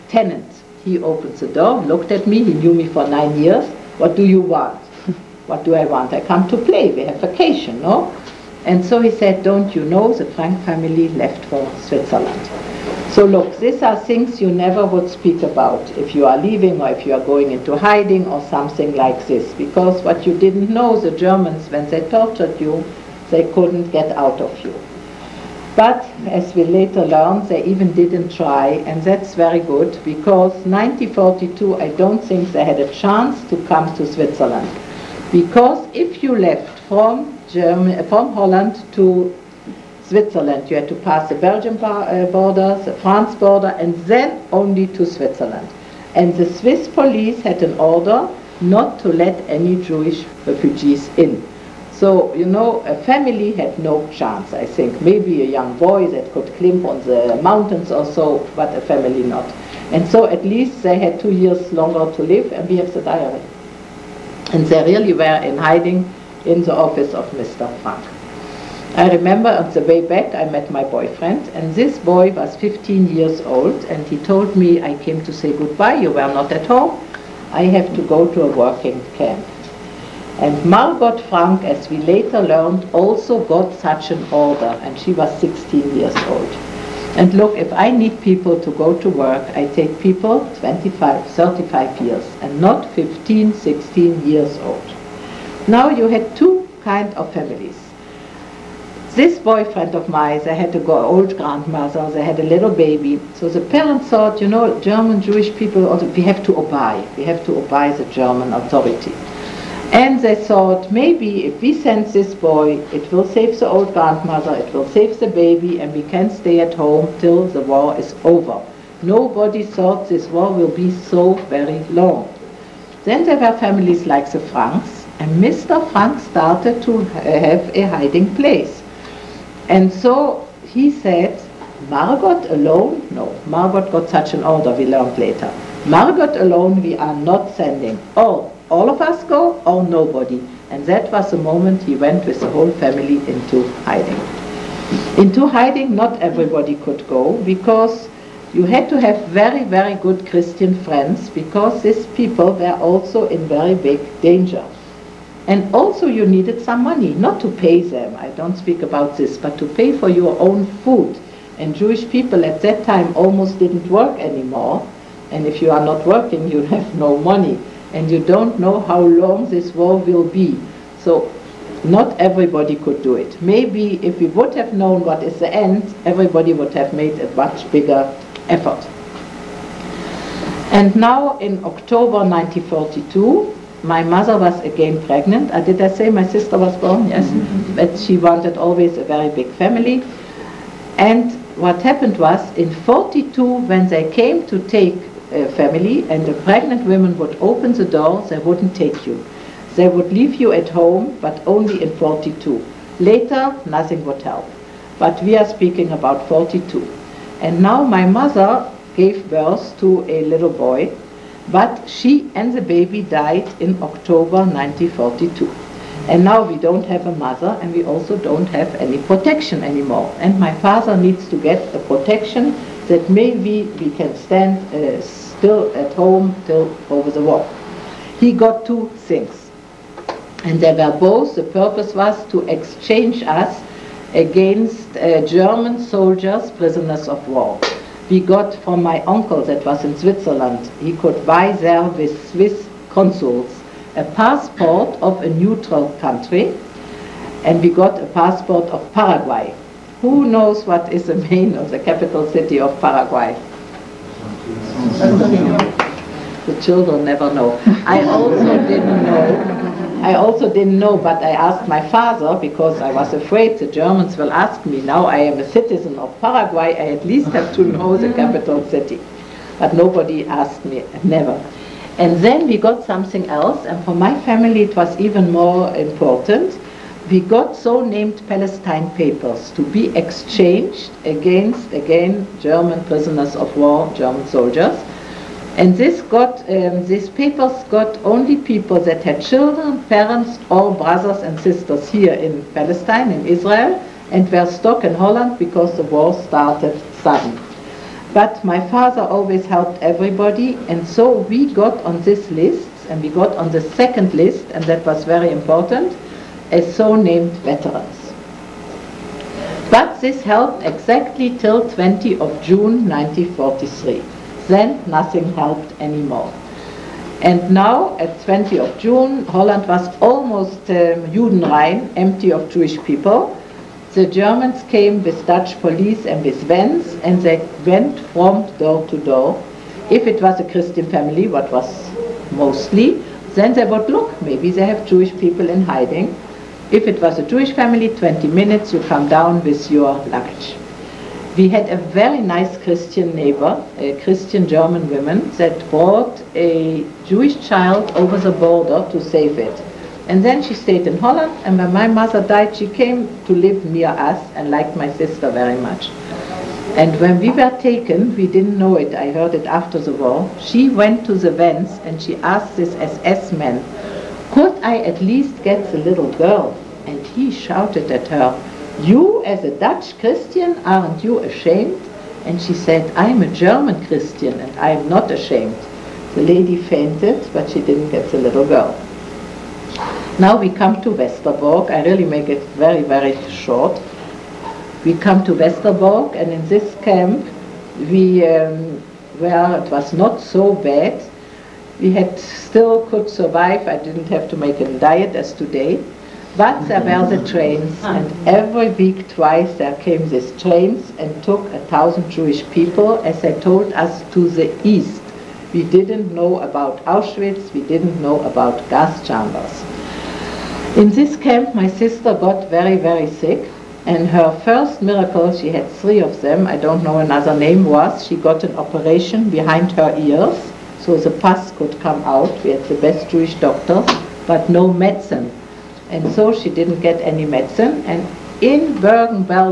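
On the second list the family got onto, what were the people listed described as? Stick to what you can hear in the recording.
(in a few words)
veterans.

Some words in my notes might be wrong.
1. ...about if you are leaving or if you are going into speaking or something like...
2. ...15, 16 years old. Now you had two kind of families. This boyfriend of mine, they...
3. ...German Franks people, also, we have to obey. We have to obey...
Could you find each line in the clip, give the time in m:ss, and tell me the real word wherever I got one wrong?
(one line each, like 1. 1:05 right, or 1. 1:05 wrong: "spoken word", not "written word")
1. 0:15 wrong: "hiding", not "speaking"
2. 1:32 right
3. 1:44 wrong: "Jewish", not "Franks".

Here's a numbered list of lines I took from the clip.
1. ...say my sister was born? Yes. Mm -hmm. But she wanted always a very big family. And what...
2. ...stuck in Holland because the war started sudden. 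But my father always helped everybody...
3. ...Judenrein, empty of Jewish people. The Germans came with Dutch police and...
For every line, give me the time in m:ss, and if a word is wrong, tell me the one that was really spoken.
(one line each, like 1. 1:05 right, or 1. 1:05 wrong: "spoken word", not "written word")
1. 3:05 right
2. 4:54 right
3. 5:21 right.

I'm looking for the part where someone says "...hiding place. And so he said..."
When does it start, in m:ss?
2:07.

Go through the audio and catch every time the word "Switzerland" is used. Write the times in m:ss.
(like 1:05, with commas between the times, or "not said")
0:11, 0:34, 0:40, 0:45, 3:59.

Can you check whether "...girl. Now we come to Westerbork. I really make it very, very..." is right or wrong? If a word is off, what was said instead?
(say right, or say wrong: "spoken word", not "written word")
right.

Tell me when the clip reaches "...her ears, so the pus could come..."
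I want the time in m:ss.
6:59.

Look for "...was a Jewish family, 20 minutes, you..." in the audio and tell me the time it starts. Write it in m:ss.
5:37.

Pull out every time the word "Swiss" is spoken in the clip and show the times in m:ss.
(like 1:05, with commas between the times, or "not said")
0:46, 4:02.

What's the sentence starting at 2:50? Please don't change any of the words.
So not everybody could do it.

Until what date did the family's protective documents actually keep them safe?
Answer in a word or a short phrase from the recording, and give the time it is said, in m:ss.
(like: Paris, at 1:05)
20 June 1943, at 5:11.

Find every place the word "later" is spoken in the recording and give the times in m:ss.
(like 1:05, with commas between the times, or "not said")
0:26, 1:21, 2:15, 3:22.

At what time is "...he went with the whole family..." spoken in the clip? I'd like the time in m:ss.
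2:21.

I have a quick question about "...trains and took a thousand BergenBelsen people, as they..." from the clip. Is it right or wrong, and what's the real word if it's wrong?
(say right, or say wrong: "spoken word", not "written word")
wrong: "Jewish", not "BergenBelsen".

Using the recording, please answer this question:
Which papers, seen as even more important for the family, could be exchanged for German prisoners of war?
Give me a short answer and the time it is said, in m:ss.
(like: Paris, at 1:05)
Palestine papers, at 4:38.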